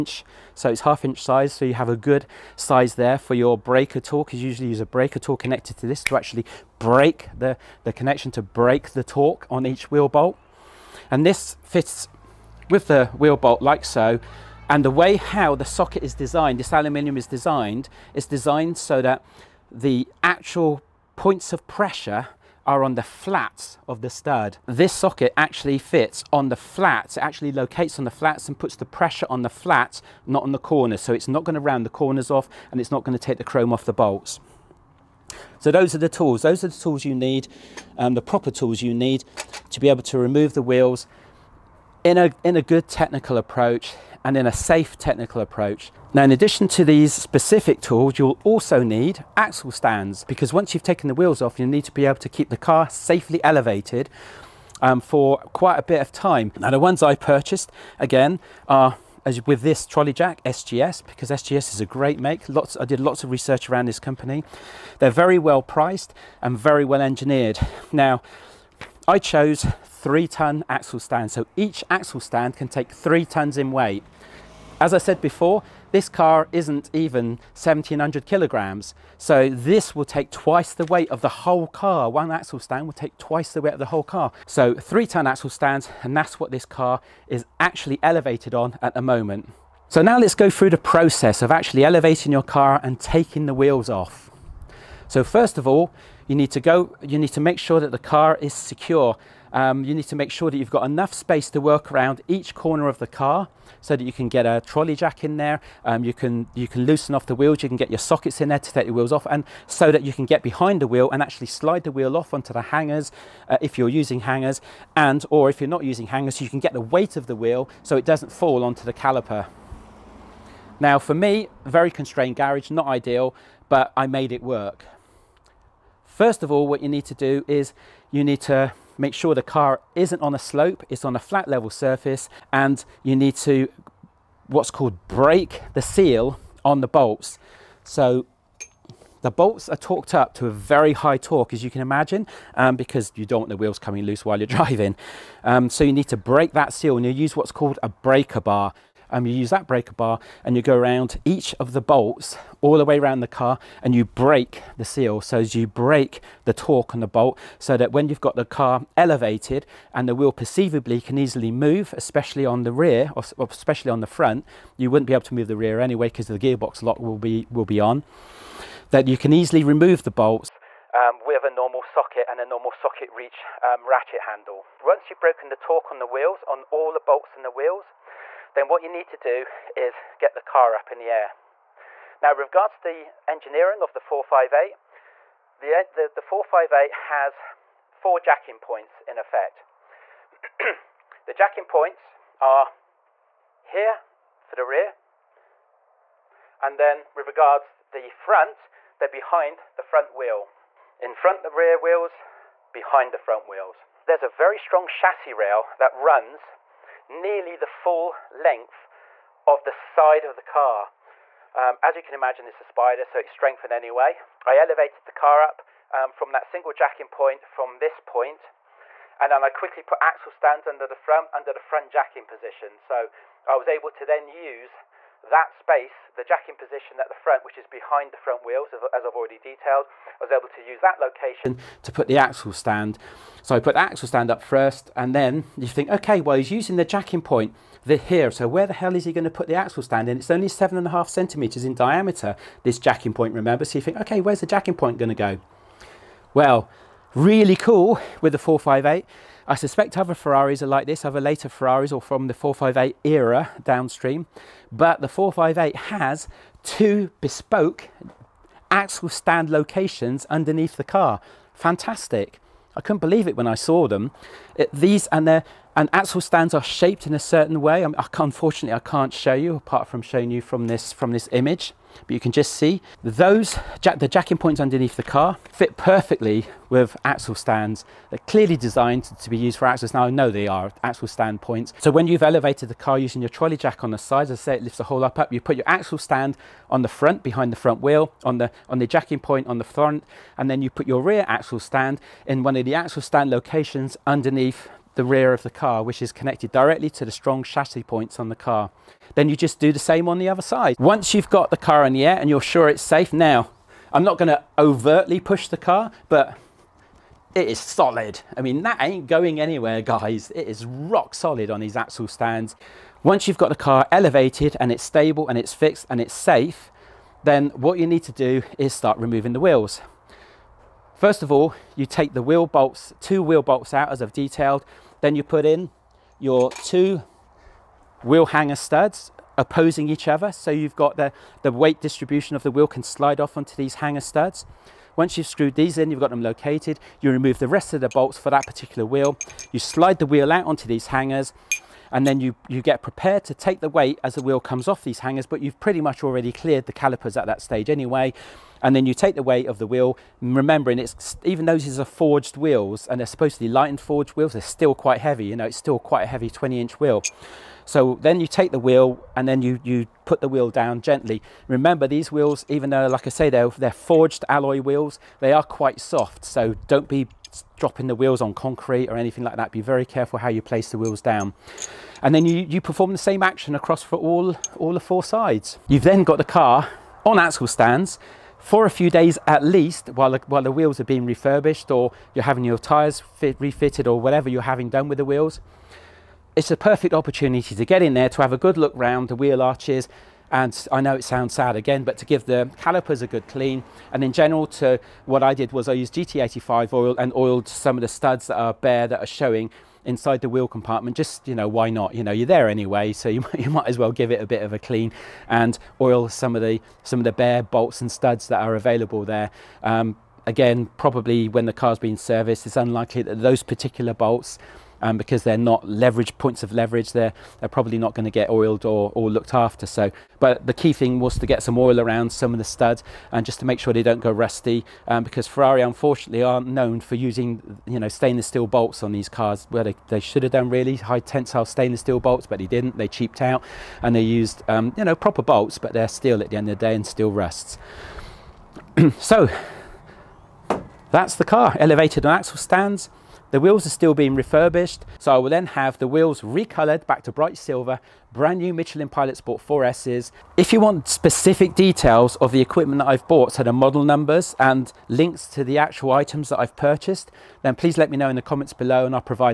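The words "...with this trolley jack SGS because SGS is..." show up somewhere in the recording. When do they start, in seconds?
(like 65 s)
59 s.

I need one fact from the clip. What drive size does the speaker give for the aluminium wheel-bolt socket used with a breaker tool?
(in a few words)
half inch.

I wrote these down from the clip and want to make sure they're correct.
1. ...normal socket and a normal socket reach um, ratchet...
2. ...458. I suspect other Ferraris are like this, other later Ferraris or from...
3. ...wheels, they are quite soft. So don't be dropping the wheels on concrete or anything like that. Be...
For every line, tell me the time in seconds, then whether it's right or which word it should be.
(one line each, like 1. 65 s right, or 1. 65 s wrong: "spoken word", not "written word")
1. 171 s right
2. 248 s right
3. 364 s right.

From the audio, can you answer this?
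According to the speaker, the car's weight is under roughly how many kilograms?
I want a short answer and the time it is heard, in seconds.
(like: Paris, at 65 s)
1700 kilograms, at 77 s.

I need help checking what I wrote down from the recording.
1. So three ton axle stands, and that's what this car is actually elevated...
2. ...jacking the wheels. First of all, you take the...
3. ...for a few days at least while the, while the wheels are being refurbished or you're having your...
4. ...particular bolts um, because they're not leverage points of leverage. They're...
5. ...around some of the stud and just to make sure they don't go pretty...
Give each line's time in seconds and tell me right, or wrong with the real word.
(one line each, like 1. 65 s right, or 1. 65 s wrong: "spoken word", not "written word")
1. 84 s right
2. 318 s wrong: "removing", not "jacking"
3. 378 s right
4. 413 s right
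5. 421 s wrong: "rusty", not "pretty".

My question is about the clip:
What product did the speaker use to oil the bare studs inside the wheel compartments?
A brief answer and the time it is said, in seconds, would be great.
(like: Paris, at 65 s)
GT85, at 395 s.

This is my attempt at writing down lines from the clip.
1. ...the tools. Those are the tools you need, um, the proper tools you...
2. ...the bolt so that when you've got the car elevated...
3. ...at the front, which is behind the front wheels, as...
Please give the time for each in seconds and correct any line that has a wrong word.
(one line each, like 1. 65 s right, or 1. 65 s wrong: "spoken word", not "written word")
1. 35 s right
2. 156 s right
3. 226 s right.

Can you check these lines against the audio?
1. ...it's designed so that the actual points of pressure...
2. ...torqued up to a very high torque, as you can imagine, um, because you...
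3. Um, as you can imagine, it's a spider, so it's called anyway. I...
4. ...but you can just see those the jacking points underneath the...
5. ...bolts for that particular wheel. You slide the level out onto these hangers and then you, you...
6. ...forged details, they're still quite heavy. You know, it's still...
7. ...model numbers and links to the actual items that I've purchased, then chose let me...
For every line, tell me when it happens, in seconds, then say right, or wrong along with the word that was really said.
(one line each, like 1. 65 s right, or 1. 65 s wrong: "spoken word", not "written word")
1. 18 s right
2. 139 s right
3. 211 s wrong: "strengthened", not "called"
4. 272 s right
5. 337 s wrong: "wheel", not "level"
6. 353 s wrong: "wheels", not "details"
7. 453 s wrong: "please", not "chose".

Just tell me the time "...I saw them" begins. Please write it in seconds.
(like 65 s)
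263 s.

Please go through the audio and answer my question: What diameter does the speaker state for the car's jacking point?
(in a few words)
7.5 centimeters.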